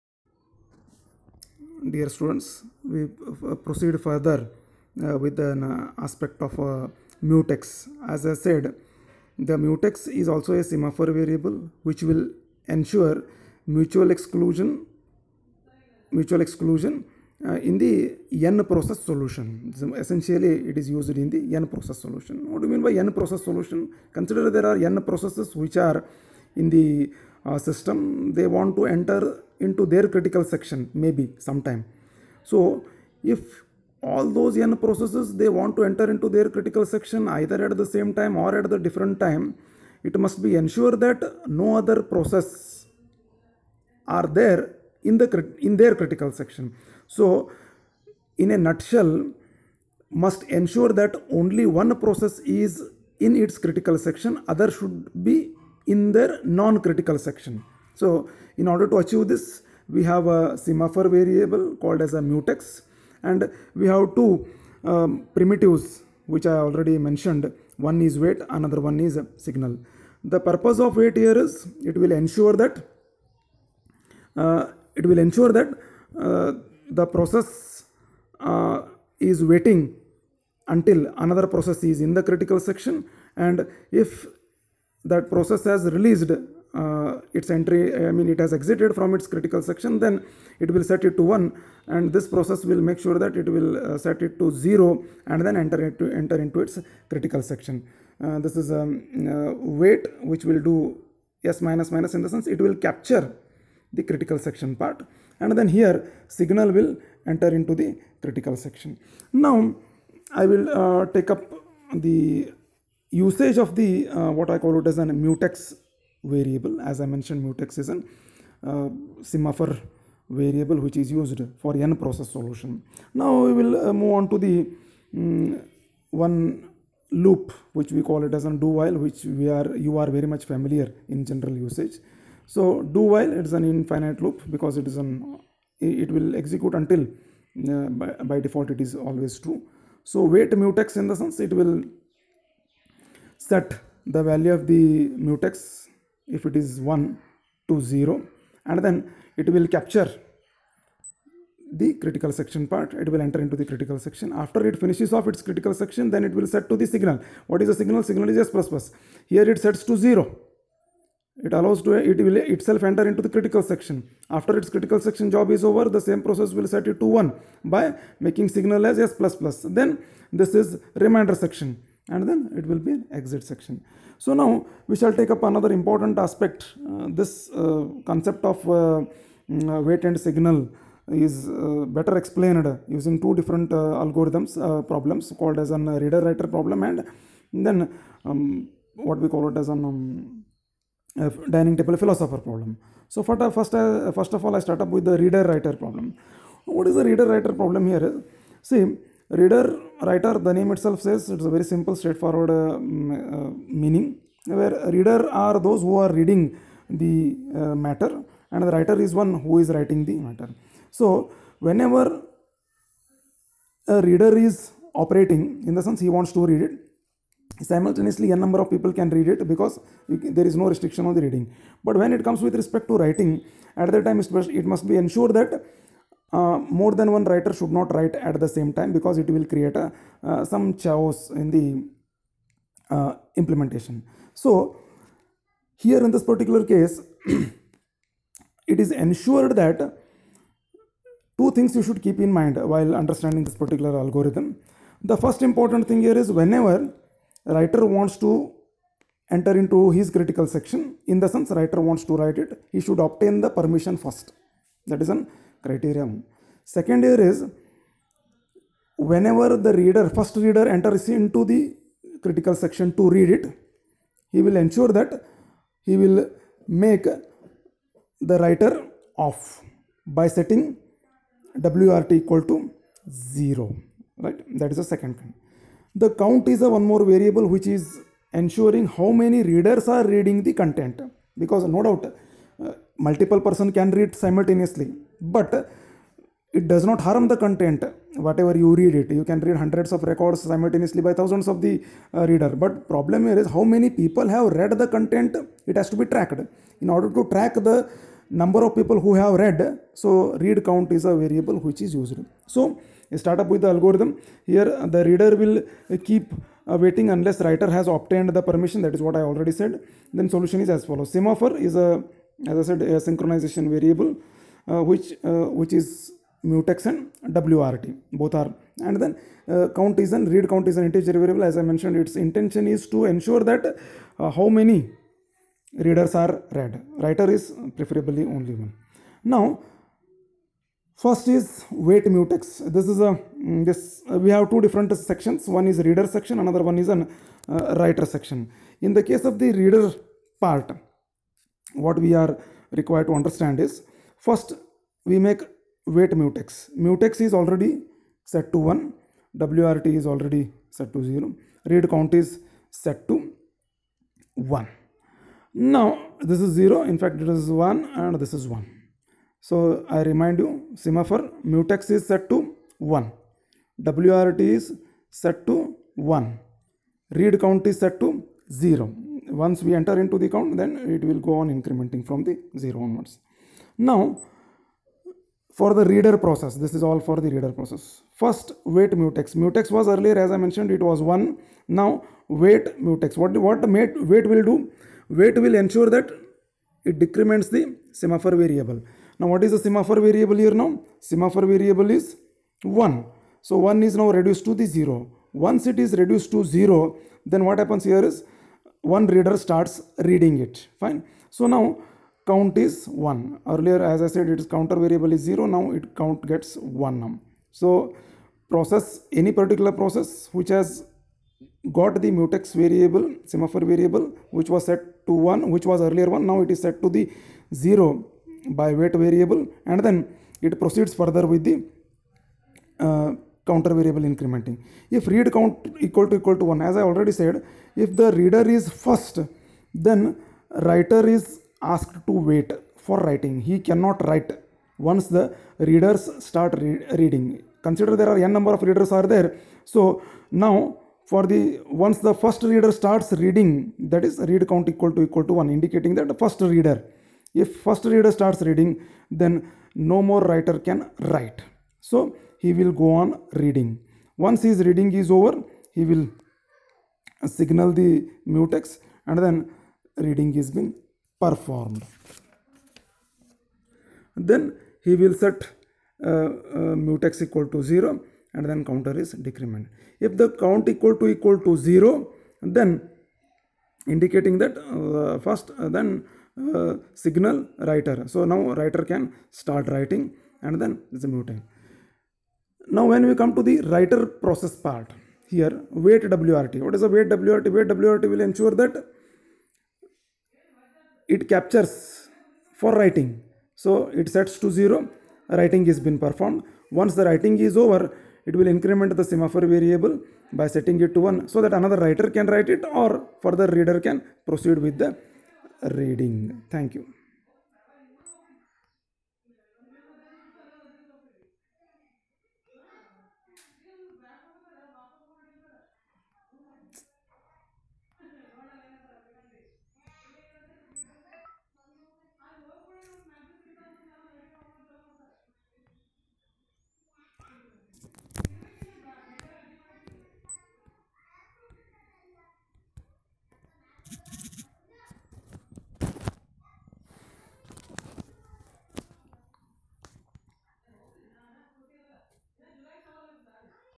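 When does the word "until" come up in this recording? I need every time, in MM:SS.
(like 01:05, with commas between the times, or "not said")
01:20, 02:16.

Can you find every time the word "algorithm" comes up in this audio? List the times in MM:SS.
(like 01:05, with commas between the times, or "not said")
03:04, 04:03, 05:03.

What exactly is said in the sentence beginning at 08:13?
So it sets to 0, writing is been performed.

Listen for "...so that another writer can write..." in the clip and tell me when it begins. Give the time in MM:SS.
08:21.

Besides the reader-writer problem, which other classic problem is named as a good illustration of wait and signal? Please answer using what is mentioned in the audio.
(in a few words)
dining table philosopher problem.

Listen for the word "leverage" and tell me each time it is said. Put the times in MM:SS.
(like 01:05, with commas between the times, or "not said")
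not said.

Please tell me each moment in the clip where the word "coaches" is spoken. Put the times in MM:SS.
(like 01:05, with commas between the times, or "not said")
not said.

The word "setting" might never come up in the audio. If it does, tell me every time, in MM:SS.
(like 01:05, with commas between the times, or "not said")
04:30, 08:20.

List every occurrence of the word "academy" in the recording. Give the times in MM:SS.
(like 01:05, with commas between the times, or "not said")
not said.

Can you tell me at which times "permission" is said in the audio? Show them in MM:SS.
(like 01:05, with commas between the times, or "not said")
04:13, 05:08.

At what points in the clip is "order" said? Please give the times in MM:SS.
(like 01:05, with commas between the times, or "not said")
00:58, 04:56.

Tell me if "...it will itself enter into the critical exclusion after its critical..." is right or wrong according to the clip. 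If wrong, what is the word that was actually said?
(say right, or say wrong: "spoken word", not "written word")
wrong: "section", not "exclusion".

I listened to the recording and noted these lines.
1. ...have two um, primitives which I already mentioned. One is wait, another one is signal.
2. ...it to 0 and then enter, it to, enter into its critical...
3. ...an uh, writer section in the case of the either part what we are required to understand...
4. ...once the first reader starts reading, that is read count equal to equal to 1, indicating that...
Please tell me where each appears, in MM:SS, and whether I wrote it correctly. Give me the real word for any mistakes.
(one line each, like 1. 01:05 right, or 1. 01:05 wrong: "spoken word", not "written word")
1. 01:03 right
2. 01:34 right
3. 05:36 wrong: "reader", not "either"
4. 07:21 right.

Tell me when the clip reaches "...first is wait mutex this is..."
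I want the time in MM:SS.
05:31.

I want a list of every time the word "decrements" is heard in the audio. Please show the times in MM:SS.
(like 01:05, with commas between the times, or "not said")
06:27, 07:49.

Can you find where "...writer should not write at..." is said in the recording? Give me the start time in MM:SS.
03:47.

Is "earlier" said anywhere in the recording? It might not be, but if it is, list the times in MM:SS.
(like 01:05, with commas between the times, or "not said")
06:19, 06:43, 06:55.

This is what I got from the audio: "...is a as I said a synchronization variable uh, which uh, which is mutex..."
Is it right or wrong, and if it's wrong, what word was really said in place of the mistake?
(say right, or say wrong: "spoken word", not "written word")
right.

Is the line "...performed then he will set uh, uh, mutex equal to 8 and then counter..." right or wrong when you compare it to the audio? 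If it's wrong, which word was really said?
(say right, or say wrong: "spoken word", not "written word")
wrong: "0", not "8".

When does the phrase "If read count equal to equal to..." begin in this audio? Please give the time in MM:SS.
07:04.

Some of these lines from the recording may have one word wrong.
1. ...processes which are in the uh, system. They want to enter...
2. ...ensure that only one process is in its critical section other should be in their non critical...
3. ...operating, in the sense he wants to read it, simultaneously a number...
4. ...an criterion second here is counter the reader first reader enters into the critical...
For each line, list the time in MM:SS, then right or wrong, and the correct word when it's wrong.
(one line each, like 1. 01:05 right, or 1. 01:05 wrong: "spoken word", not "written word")
1. 00:25 right
2. 00:50 right
3. 03:34 right
4. 04:15 wrong: "whenever", not "counter".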